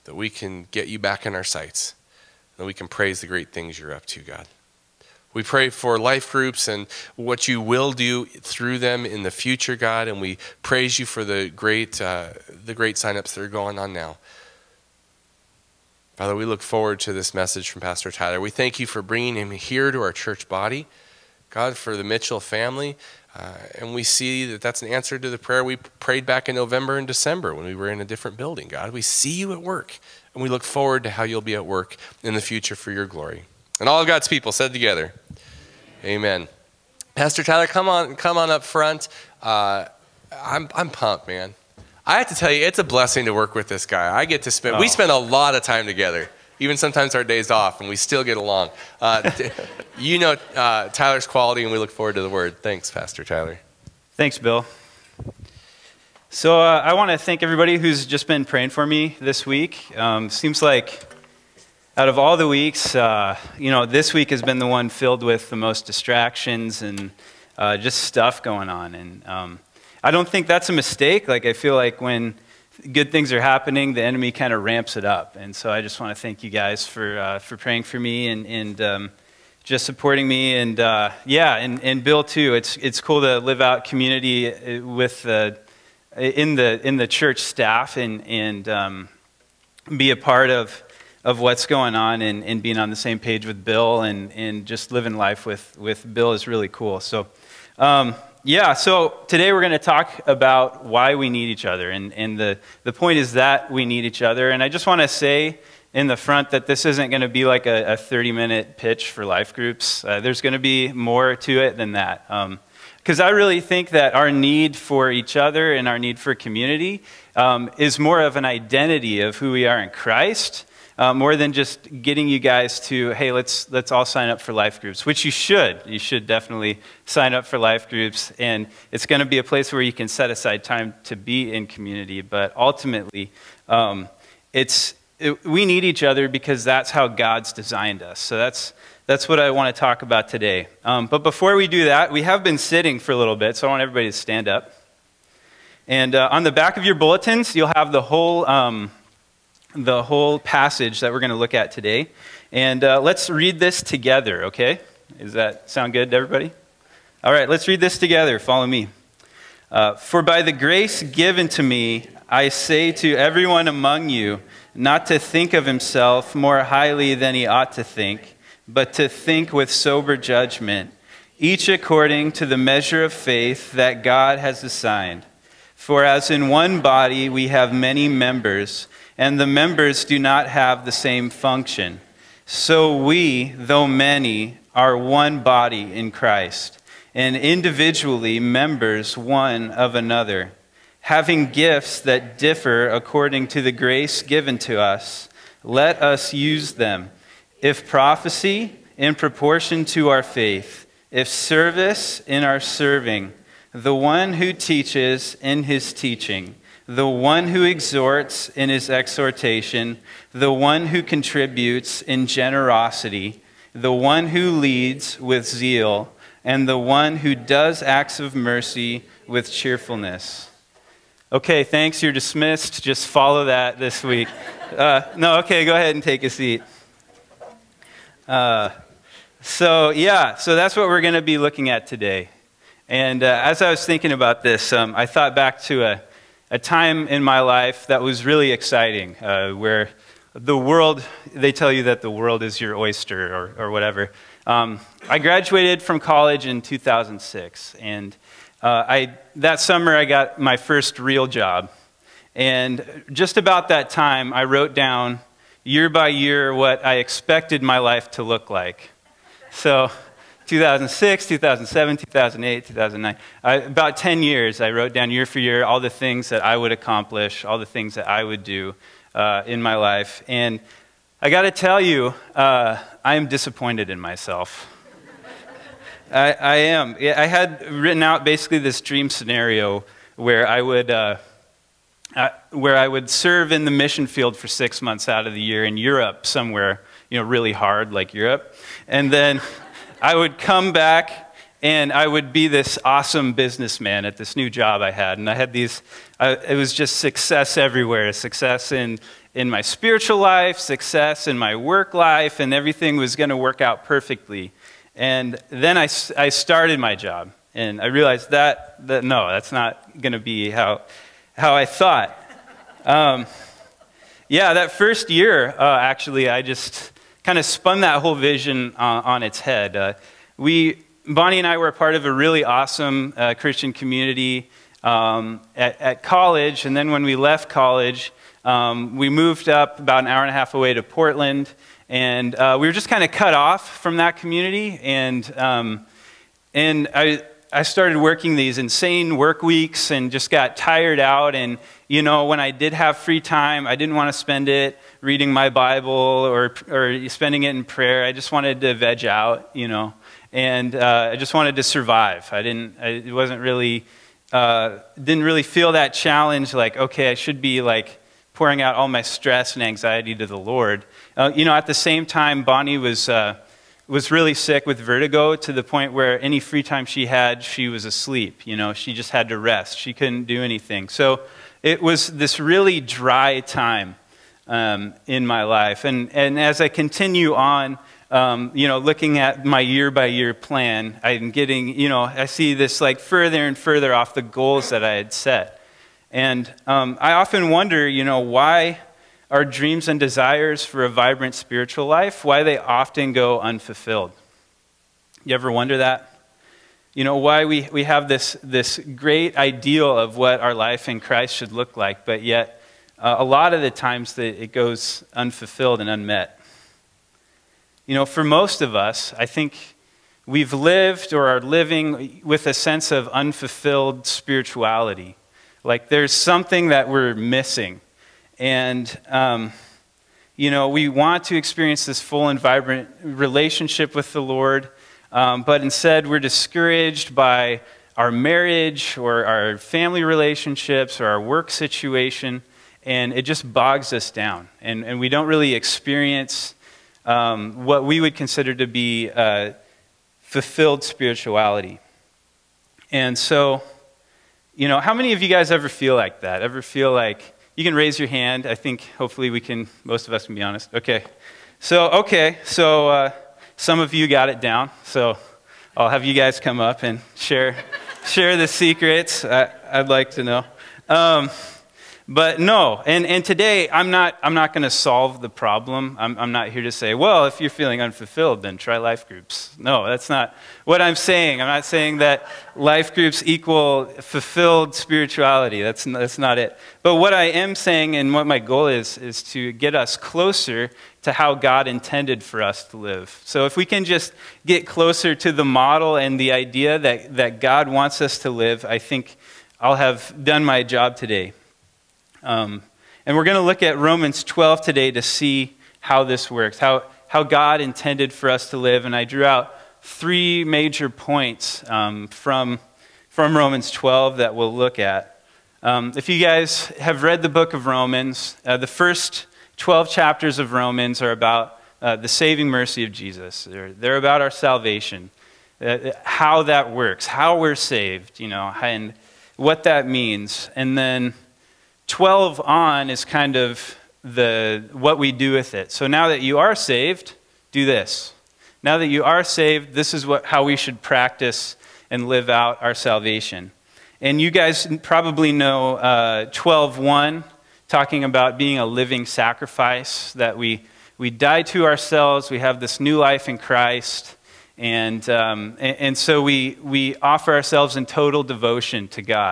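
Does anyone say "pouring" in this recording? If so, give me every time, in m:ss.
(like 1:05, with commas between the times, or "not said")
5:58.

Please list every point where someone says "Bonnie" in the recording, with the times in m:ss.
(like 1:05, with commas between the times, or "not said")
5:21, 6:02.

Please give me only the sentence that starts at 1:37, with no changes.
So, um, yeah, so today we're going to talk about why we need each other.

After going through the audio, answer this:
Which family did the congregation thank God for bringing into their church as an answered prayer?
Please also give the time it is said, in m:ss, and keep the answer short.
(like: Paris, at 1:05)
Mitchell, at 0:22.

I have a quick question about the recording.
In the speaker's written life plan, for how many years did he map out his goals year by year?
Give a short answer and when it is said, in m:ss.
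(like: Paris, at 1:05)
10, at 4:23.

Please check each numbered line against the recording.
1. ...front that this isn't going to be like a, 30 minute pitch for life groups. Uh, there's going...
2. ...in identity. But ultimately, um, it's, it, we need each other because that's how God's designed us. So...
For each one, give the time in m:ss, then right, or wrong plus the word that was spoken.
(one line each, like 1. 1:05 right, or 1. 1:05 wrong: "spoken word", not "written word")
1. 1:46 right
2. 2:11 wrong: "community", not "identity".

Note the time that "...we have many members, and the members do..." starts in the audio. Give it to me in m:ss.
2:57.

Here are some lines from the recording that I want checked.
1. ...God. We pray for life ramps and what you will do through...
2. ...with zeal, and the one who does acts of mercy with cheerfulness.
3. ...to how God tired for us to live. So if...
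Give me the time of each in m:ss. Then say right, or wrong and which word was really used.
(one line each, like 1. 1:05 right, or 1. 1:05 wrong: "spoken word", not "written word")
1. 0:04 wrong: "groups", not "ramps"
2. 3:35 right
3. 8:01 wrong: "intended", not "tired".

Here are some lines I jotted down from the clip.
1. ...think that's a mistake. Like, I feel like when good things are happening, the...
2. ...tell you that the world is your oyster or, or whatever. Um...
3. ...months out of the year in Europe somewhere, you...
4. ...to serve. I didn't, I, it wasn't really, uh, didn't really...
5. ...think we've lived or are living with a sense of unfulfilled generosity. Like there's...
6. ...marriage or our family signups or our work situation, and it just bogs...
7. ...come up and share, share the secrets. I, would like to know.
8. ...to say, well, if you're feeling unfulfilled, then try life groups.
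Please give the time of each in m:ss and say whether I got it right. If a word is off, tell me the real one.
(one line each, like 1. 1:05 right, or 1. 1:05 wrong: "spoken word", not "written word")
1. 1:10 right
2. 4:01 right
3. 4:44 right
4. 5:51 wrong: "survive", not "serve"
5. 6:49 wrong: "spirituality", not "generosity"
6. 7:08 wrong: "relationships", not "signups"
7. 7:36 right
8. 7:46 right.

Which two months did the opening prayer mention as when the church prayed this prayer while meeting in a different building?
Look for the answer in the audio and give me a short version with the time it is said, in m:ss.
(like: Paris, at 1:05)
November and December, at 0:26.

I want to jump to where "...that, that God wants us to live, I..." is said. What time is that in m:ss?
8:06.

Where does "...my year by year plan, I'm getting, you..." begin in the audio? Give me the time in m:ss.
6:19.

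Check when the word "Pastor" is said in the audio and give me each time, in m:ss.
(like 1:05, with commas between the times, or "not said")
0:17, 0:37, 0:52.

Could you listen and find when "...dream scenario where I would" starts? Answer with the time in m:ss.
4:38.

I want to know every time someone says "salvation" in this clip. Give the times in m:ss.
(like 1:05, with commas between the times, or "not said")
8:34, 8:52.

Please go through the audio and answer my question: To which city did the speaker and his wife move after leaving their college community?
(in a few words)
Portland.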